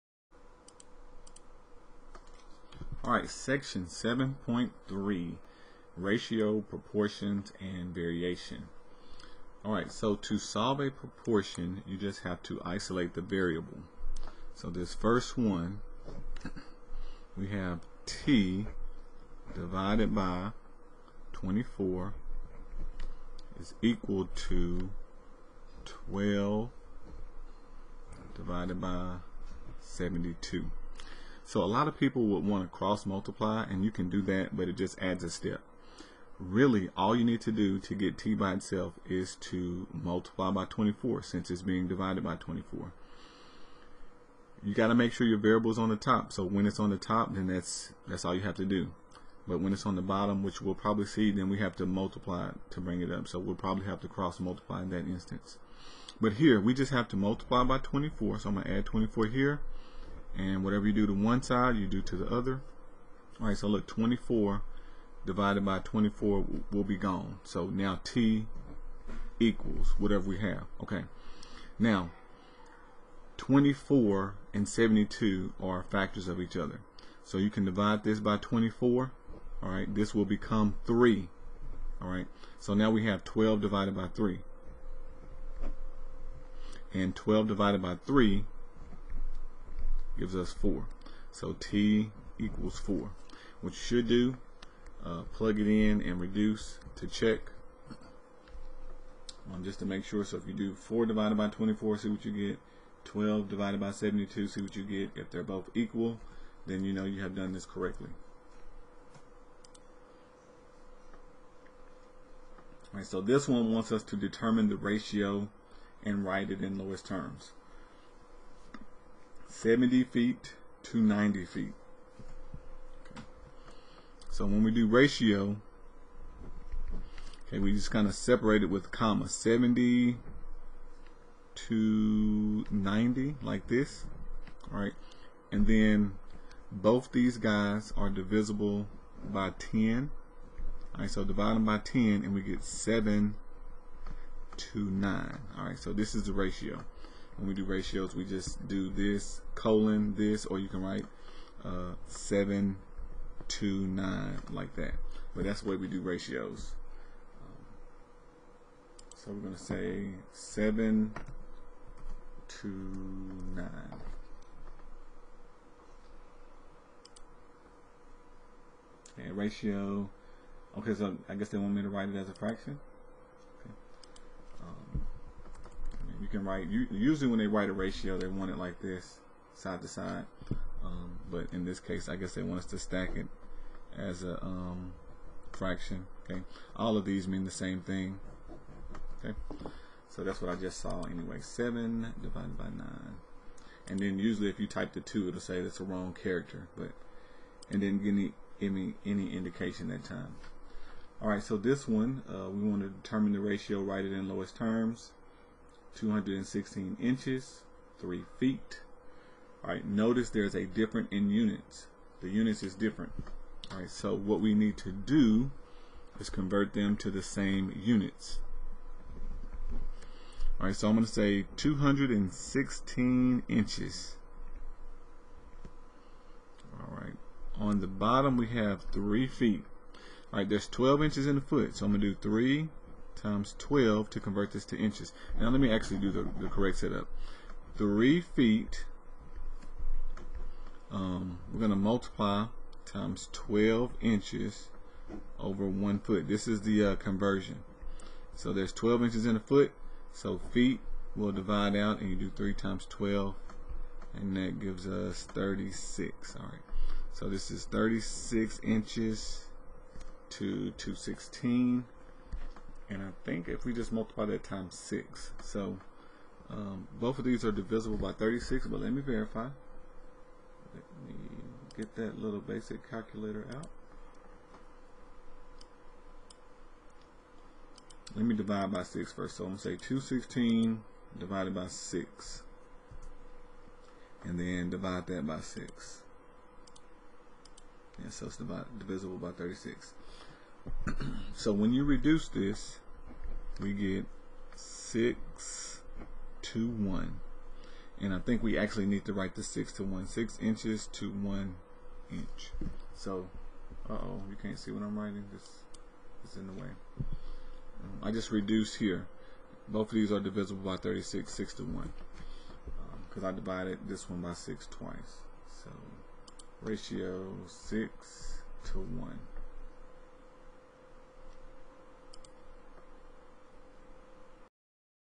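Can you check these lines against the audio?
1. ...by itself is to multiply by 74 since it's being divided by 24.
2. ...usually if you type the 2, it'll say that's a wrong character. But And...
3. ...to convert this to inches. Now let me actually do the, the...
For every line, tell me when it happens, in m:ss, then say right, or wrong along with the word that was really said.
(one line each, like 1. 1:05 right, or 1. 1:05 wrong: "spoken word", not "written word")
1. 0:38 wrong: "24", not "74"
2. 3:14 right
3. 3:54 right.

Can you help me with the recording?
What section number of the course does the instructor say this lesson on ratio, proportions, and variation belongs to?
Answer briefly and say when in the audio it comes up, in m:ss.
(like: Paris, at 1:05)
7.3, at 0:03.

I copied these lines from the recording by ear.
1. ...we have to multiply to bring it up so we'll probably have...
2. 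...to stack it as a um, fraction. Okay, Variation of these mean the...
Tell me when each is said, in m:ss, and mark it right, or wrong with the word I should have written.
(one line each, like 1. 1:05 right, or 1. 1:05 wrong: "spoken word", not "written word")
1. 0:51 right
2. 3:02 wrong: "All", not "Variation".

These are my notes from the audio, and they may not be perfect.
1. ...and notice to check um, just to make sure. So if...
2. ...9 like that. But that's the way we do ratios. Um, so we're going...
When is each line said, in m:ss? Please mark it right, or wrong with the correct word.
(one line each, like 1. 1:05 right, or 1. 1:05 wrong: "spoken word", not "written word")
1. 1:36 wrong: "reduce", not "notice"
2. 2:33 right.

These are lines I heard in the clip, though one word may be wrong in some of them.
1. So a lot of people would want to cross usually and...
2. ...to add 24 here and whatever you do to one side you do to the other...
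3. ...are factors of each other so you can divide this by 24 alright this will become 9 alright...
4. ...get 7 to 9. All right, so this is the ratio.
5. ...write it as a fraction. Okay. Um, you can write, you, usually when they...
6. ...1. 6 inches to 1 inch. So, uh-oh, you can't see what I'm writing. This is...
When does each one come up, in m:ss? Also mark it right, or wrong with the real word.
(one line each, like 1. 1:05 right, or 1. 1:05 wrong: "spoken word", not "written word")
1. 0:31 wrong: "multiply", not "usually"
2. 0:58 right
3. 1:15 wrong: "3", not "9"
4. 2:22 right
5. 2:51 right
6. 4:59 right.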